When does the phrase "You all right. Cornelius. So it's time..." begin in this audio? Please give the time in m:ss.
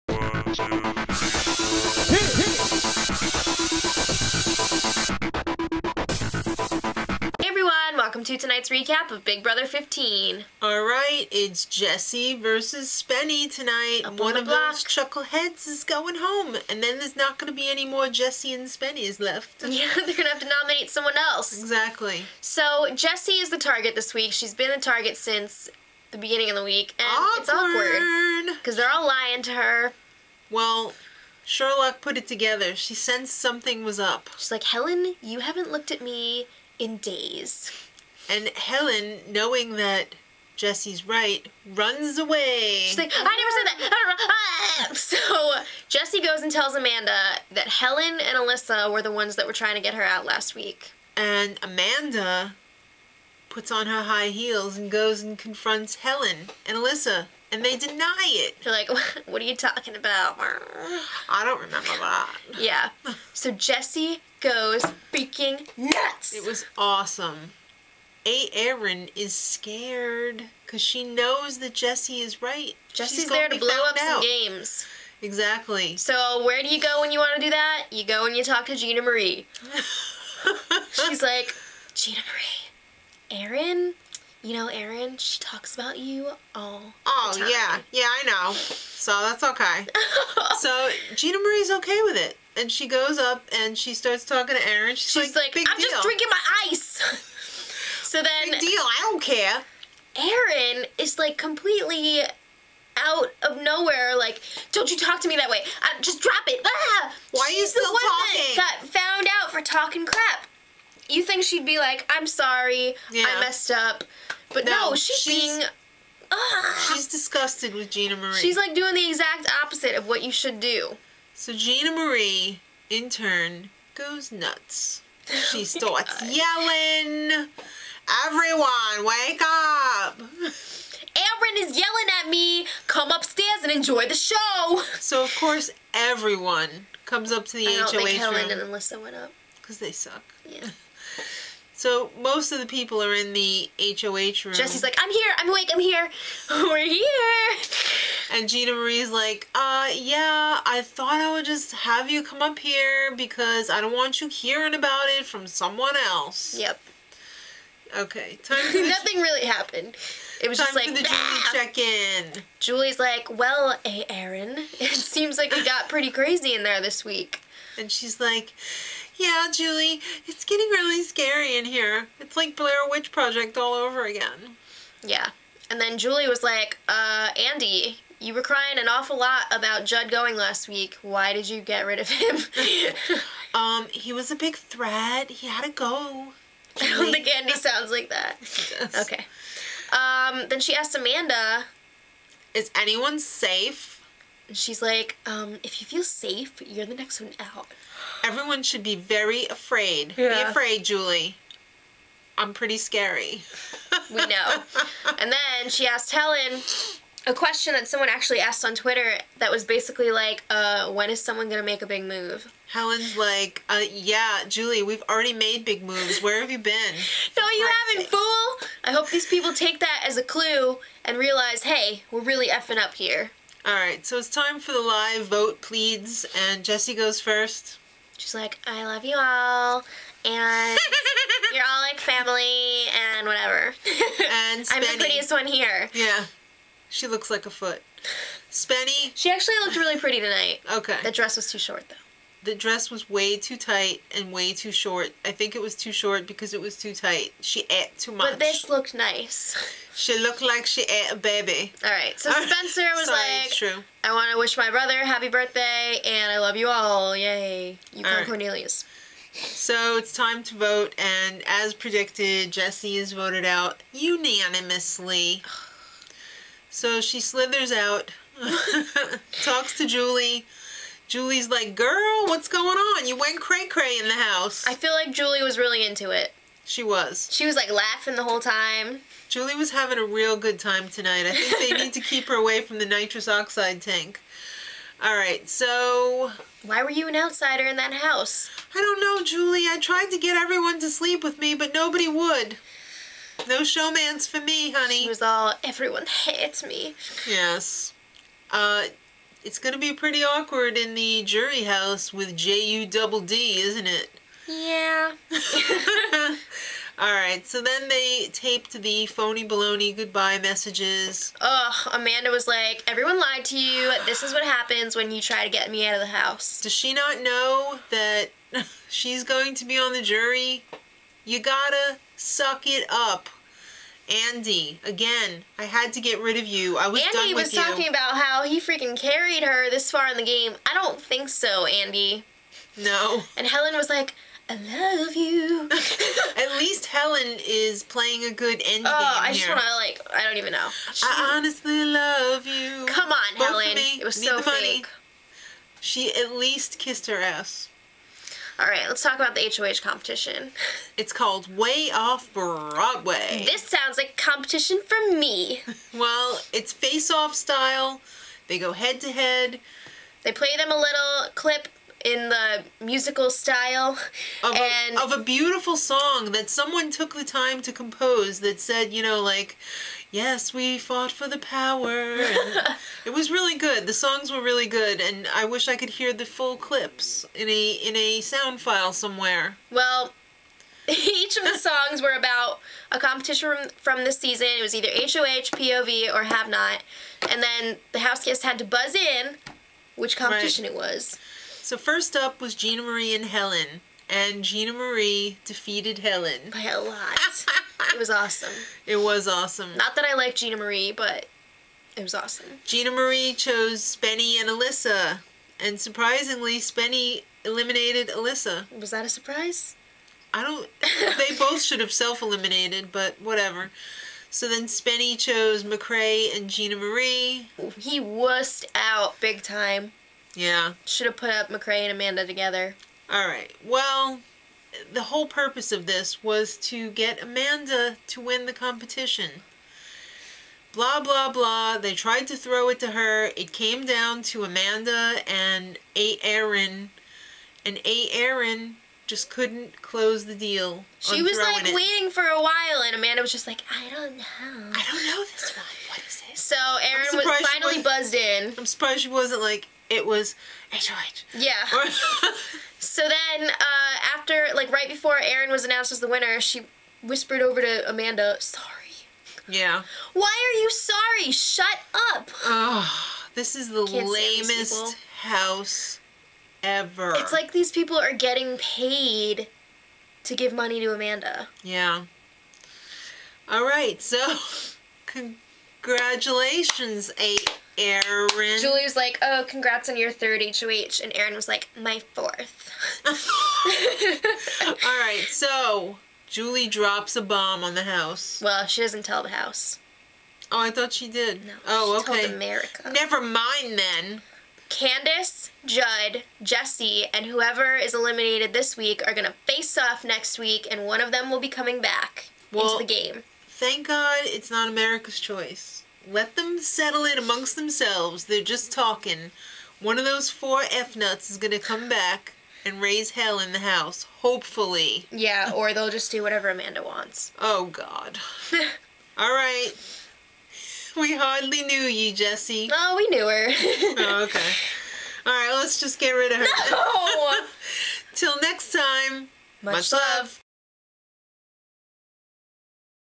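4:17.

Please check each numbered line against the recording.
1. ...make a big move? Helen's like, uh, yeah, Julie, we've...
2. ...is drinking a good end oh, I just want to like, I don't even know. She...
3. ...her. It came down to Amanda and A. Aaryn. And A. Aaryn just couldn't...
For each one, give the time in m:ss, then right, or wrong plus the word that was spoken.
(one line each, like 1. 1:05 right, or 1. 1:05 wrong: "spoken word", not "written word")
1. 3:31 right
2. 5:37 wrong: "playing", not "drinking"
3. 7:12 right.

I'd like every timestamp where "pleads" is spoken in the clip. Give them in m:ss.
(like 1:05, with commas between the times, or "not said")
3:45.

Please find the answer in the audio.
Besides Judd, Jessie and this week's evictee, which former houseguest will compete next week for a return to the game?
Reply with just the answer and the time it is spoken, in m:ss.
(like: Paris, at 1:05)
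Candice, at 8:14.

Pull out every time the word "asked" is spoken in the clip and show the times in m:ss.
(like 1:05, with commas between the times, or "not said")
3:28.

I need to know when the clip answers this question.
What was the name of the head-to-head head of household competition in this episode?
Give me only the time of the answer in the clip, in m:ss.
5:51.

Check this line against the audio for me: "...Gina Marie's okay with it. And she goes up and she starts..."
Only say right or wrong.
right.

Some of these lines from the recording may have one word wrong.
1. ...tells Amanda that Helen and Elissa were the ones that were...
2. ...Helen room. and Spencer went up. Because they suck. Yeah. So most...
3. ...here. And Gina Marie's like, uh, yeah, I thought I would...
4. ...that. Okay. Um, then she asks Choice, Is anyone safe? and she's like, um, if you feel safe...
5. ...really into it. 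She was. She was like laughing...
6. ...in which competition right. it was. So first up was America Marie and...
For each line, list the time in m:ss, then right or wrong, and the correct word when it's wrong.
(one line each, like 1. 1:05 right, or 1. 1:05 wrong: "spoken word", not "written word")
1. 0:46 right
2. 2:18 wrong: "Elissa", not "Spencer"
3. 2:26 right
4. 3:08 wrong: "Amanda", not "Choice"
5. 4:35 right
6. 6:28 wrong: "Gina", not "America".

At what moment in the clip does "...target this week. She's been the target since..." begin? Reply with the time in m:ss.
0:23.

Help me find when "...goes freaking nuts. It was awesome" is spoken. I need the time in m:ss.
1:04.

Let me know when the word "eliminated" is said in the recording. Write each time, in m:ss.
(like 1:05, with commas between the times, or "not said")
6:47, 6:51, 8:17.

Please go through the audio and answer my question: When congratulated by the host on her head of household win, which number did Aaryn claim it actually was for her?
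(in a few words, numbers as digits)
Fourth.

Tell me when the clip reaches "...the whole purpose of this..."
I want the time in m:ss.
7:04.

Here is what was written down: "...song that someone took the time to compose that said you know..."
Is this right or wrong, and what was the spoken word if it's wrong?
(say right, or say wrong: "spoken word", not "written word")
right.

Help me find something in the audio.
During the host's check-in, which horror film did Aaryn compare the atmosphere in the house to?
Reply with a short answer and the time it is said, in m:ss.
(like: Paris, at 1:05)
Blair Witch Project, at 2:52.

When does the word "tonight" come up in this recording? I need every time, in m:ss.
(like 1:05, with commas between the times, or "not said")
0:08, 0:13, 4:00, 4:40.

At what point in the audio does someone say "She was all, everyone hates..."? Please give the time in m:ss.
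4:55.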